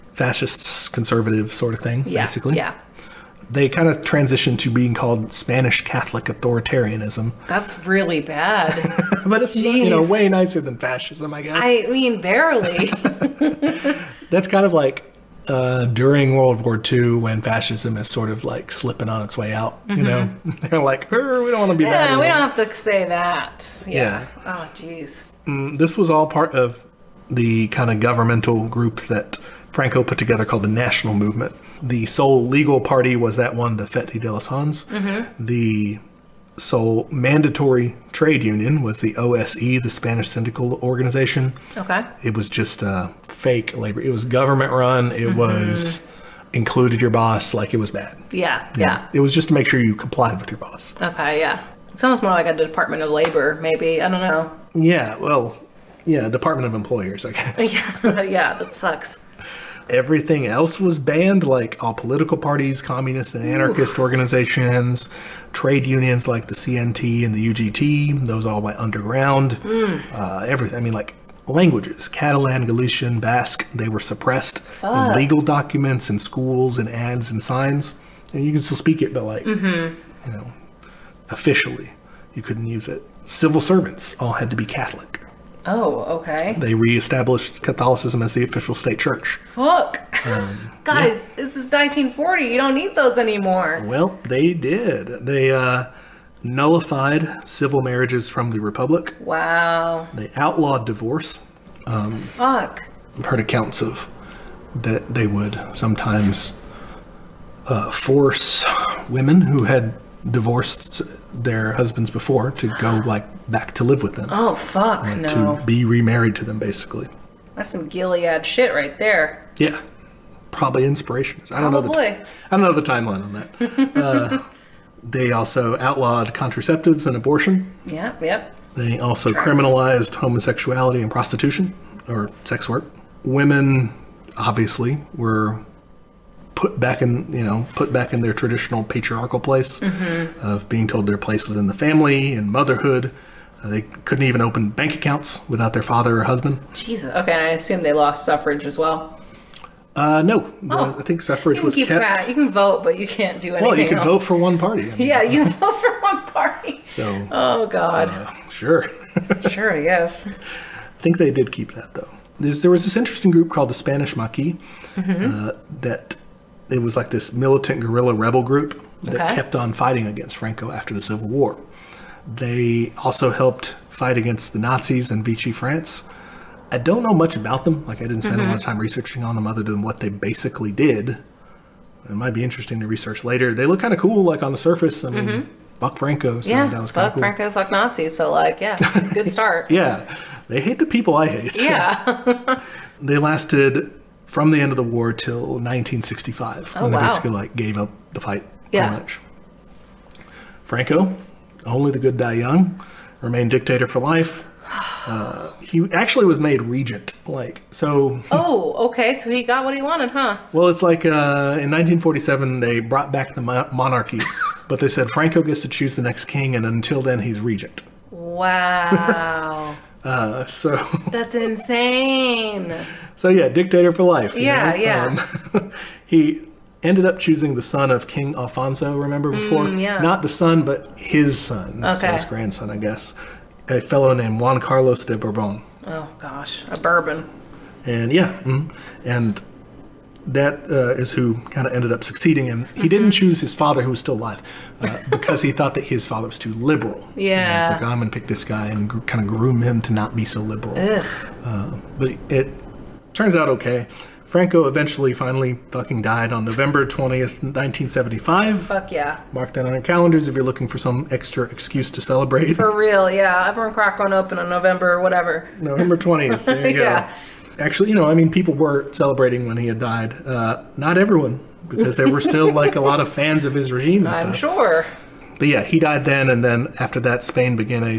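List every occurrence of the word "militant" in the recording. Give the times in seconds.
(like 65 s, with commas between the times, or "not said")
167 s.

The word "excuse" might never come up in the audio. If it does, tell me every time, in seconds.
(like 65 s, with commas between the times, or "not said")
261 s.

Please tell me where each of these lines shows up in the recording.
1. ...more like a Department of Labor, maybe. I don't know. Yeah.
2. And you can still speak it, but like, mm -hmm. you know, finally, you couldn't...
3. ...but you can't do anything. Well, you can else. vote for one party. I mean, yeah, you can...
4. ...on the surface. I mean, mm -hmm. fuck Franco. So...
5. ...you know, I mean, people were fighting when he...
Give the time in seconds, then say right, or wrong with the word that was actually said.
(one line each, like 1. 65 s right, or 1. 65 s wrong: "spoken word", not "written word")
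1. 52 s right
2. 78 s wrong: "officially", not "finally"
3. 152 s right
4. 184 s right
5. 267 s wrong: "celebrating", not "fighting".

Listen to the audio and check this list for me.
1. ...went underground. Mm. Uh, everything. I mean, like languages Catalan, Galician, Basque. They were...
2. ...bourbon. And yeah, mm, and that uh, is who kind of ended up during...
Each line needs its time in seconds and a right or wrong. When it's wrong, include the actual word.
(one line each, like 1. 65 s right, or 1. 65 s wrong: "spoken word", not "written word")
1. 68 s right
2. 236 s wrong: "succeeding", not "during".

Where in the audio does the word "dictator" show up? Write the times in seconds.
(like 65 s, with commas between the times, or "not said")
203 s, 223 s.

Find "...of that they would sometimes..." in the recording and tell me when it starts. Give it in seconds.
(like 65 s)
103 s.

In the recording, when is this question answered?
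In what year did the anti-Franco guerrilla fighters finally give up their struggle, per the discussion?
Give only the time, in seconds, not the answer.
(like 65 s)
195 s.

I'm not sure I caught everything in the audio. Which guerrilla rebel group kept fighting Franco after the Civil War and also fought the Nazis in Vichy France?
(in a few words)
Spanish Maquis.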